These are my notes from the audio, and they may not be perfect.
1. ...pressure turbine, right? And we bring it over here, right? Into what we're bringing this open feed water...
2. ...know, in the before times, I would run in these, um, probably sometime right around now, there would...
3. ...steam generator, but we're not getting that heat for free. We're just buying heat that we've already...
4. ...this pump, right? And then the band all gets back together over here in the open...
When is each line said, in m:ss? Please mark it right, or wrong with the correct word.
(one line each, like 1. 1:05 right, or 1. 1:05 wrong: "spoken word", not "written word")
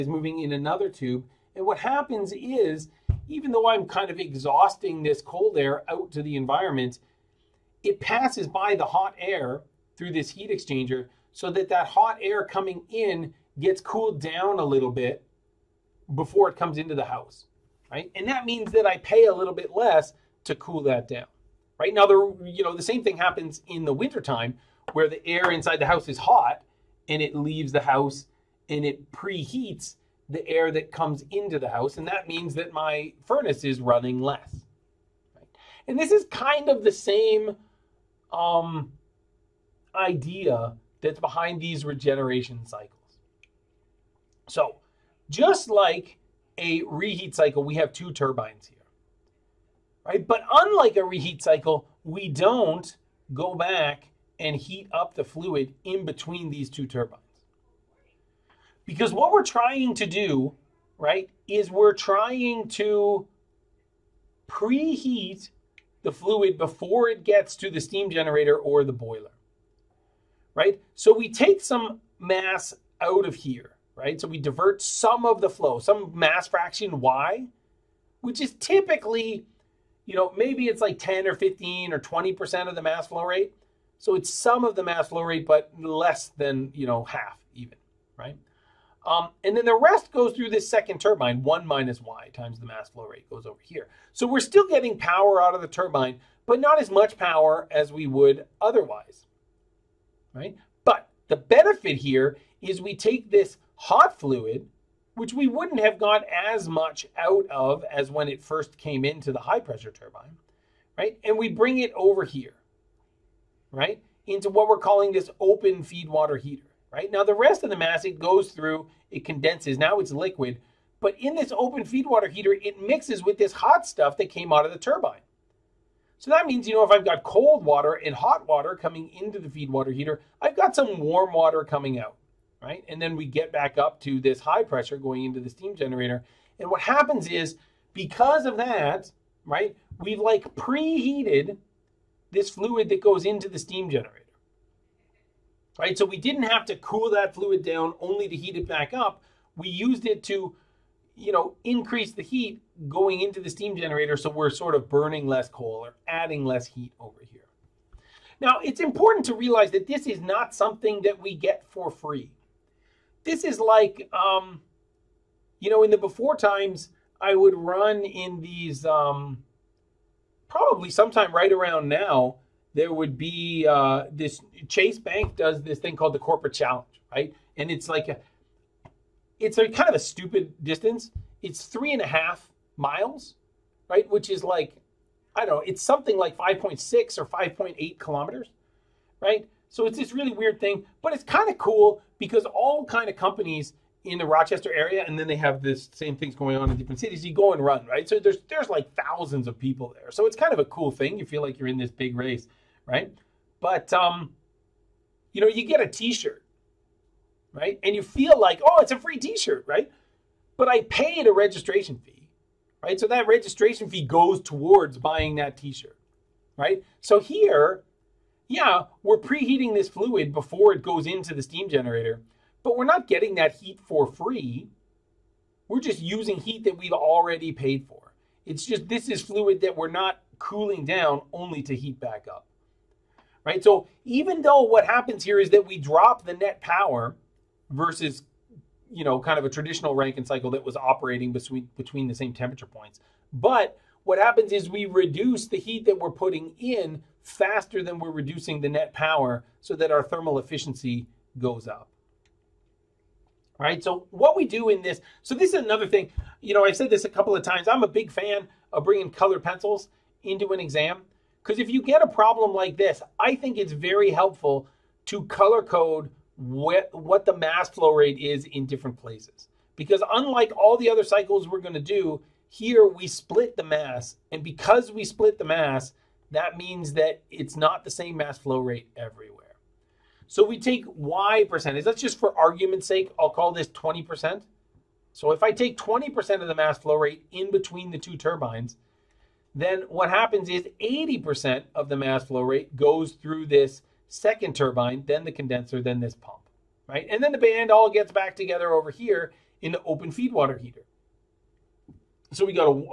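1. 1:49 wrong: "calling", not "bringing"
2. 2:45 right
3. 3:41 wrong: "using", not "buying"
4. 4:55 right.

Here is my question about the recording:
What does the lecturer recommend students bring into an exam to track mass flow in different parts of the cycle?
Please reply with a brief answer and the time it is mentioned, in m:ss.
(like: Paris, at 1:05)
Colored pencils, at 4:19.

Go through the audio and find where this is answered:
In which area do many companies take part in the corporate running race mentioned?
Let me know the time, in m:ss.
3:14.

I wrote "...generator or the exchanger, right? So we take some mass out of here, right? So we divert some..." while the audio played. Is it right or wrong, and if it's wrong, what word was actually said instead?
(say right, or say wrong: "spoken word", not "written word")
wrong: "boiler", not "exchanger".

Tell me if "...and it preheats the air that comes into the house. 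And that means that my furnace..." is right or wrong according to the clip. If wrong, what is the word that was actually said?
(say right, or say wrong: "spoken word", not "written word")
right.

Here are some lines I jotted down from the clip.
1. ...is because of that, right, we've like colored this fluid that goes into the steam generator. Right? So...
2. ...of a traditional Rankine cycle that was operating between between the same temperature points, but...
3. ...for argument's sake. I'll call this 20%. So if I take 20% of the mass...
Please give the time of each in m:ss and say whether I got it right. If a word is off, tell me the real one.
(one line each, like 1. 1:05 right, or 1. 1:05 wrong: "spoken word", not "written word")
1. 2:17 wrong: "preheated", not "colored"
2. 3:59 right
3. 4:42 right.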